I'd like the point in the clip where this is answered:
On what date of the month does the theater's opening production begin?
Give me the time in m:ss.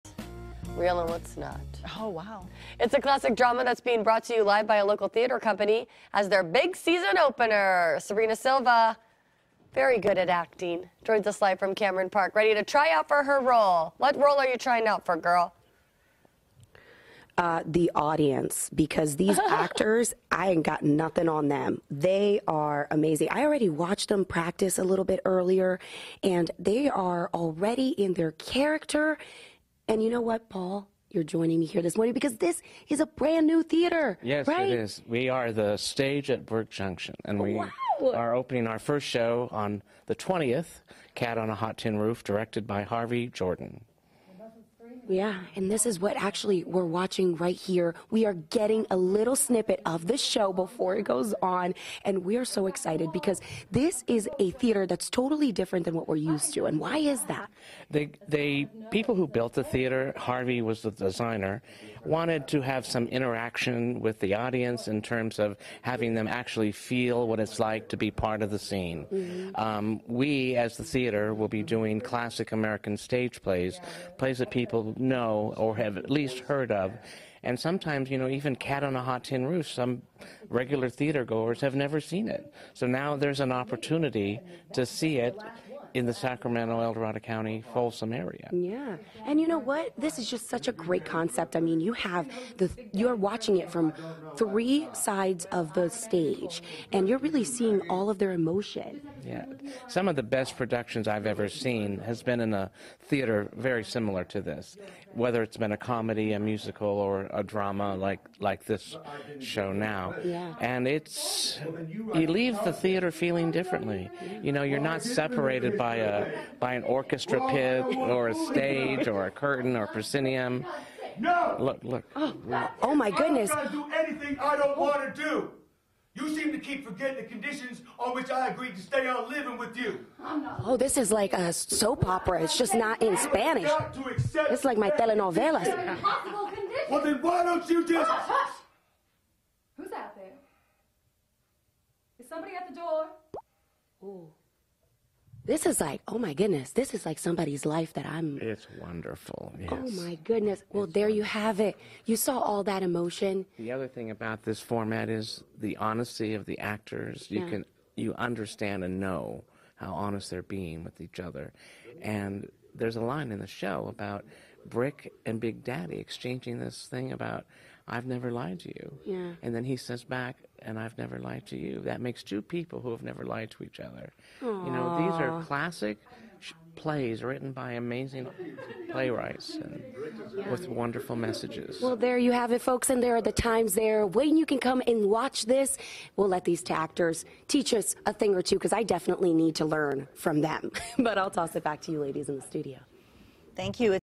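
0:40.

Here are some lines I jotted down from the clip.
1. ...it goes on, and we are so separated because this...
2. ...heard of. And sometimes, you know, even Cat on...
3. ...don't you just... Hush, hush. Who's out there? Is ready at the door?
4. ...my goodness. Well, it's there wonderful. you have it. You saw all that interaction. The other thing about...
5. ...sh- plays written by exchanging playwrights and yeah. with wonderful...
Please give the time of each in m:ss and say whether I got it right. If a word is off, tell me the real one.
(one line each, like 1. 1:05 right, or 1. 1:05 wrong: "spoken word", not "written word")
1. 0:50 wrong: "excited", not "separated"
2. 1:16 right
3. 2:17 wrong: "somebody", not "ready"
4. 2:30 wrong: "emotion", not "interaction"
5. 2:56 wrong: "amazing", not "exchanging".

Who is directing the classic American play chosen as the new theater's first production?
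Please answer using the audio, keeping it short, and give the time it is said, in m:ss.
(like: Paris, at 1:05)
Harvey Jordan, at 0:42.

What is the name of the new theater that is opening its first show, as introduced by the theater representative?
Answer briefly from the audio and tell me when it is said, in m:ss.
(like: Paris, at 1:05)
The Stage at Burke Junction, at 0:35.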